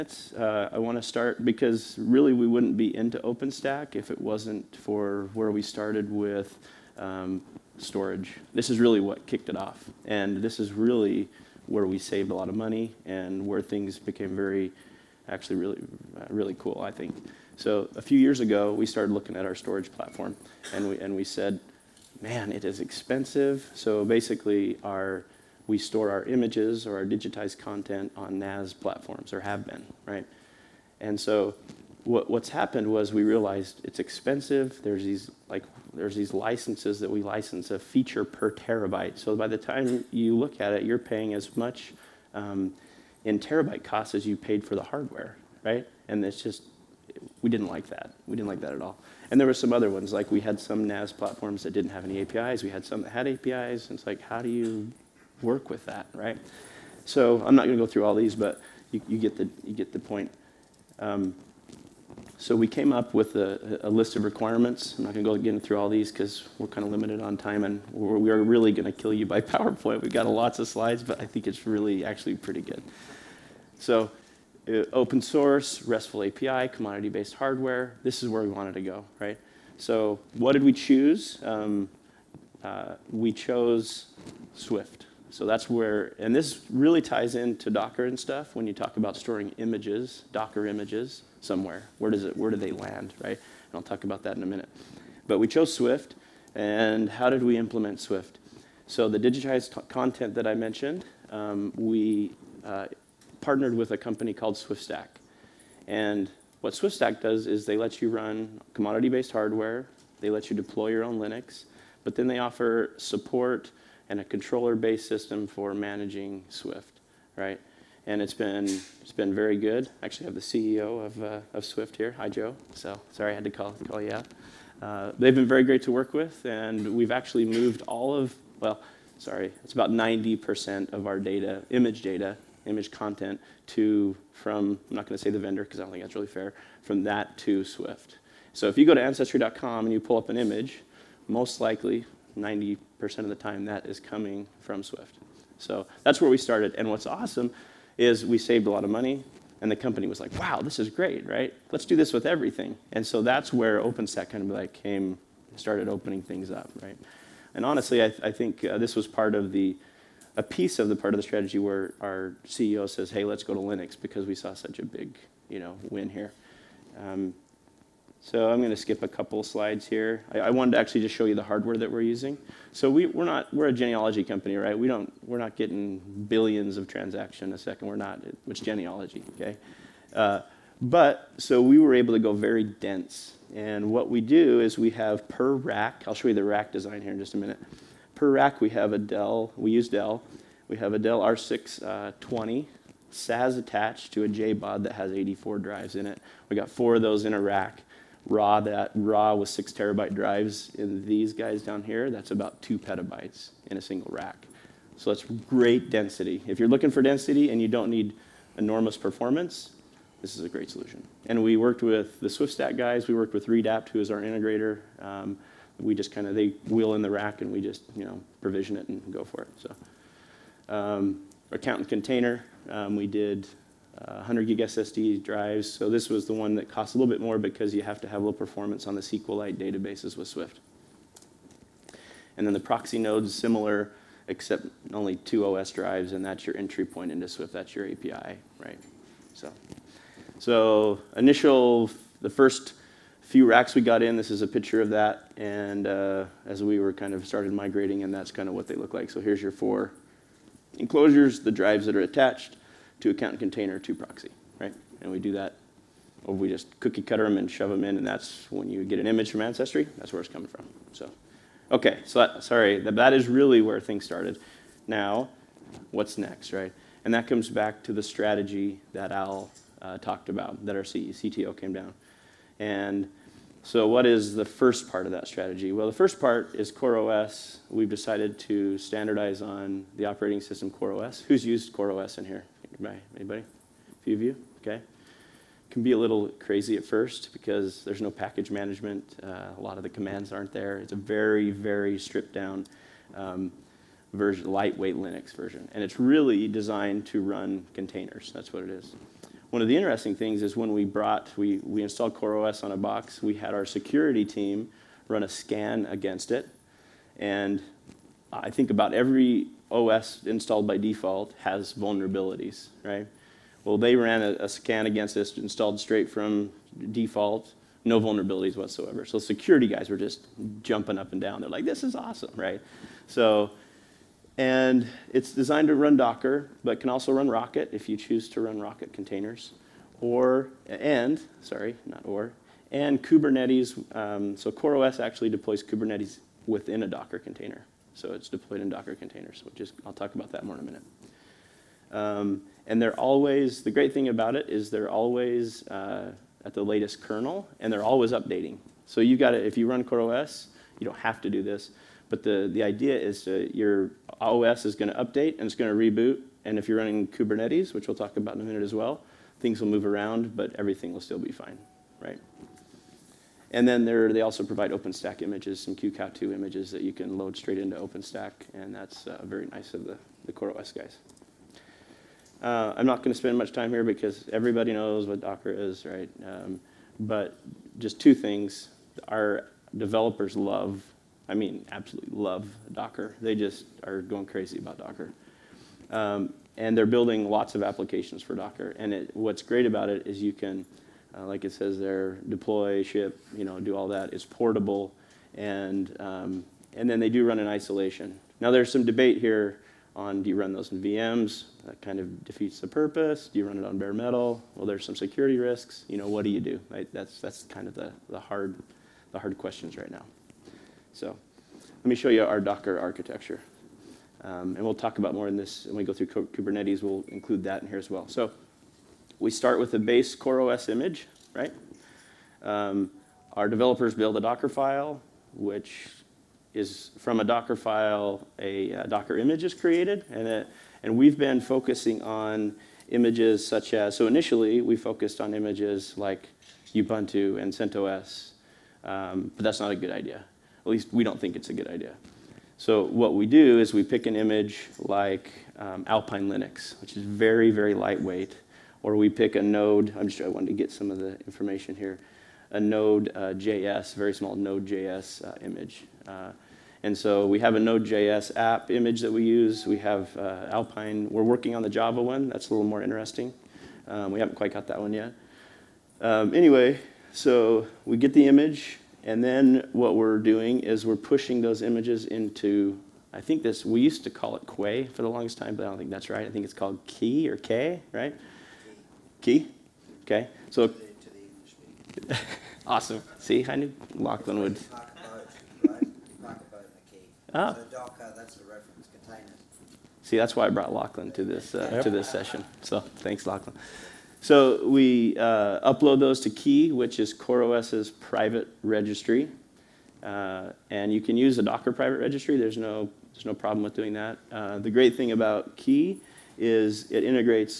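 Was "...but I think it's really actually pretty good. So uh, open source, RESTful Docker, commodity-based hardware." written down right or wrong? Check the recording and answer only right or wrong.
wrong.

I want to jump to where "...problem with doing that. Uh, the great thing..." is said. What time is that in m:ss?
8:23.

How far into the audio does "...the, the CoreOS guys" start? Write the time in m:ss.
6:09.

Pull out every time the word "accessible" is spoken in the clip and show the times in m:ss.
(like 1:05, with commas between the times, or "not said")
not said.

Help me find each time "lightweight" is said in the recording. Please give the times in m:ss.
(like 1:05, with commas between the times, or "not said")
4:54, 7:27.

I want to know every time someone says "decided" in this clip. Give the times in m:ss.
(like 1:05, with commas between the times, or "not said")
4:37.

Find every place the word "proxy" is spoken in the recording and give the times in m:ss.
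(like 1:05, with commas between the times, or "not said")
3:52, 4:13.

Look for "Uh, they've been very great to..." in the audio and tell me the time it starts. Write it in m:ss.
2:04.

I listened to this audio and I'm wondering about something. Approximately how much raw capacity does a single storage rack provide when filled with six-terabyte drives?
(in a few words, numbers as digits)
2 petabytes.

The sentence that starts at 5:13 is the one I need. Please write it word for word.
Well, they ran a, a scan against this installed straight from default, no vulnerabilities whatsoever.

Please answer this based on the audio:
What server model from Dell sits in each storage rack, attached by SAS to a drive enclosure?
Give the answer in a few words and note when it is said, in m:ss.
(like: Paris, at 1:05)
R620, at 3:11.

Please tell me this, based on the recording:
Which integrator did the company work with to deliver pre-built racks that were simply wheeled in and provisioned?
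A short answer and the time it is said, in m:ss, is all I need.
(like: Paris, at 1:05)
Redapt, at 3:33.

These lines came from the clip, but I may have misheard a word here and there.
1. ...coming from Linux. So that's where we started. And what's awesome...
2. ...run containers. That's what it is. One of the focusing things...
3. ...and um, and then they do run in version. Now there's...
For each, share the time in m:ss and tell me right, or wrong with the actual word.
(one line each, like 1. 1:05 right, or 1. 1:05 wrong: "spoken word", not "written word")
1. 2:23 wrong: "Swift", not "Linux"
2. 4:57 wrong: "interesting", not "focusing"
3. 6:35 wrong: "isolation", not "version".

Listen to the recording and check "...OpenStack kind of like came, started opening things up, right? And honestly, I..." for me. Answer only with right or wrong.
right.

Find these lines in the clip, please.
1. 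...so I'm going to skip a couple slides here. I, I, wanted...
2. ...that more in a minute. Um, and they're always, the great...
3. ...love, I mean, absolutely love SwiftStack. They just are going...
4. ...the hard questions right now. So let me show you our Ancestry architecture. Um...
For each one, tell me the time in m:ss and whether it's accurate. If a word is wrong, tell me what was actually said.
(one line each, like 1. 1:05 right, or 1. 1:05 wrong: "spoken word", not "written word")
1. 2:48 right
2. 5:40 right
3. 6:20 wrong: "Docker", not "SwiftStack"
4. 6:49 wrong: "Docker", not "Ancestry".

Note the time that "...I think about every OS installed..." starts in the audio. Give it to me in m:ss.
5:08.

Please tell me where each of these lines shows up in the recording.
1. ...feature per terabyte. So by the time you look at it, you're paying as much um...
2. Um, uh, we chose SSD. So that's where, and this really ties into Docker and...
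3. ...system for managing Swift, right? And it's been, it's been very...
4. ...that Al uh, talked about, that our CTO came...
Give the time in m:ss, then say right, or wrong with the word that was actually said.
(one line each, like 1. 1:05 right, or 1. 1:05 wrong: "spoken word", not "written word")
1. 0:37 right
2. 1:21 wrong: "Swift", not "SSD"
3. 1:55 right
4. 4:28 right.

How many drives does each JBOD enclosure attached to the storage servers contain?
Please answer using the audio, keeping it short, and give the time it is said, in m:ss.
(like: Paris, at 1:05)
84, at 3:15.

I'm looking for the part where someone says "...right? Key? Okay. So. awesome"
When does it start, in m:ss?
7:57.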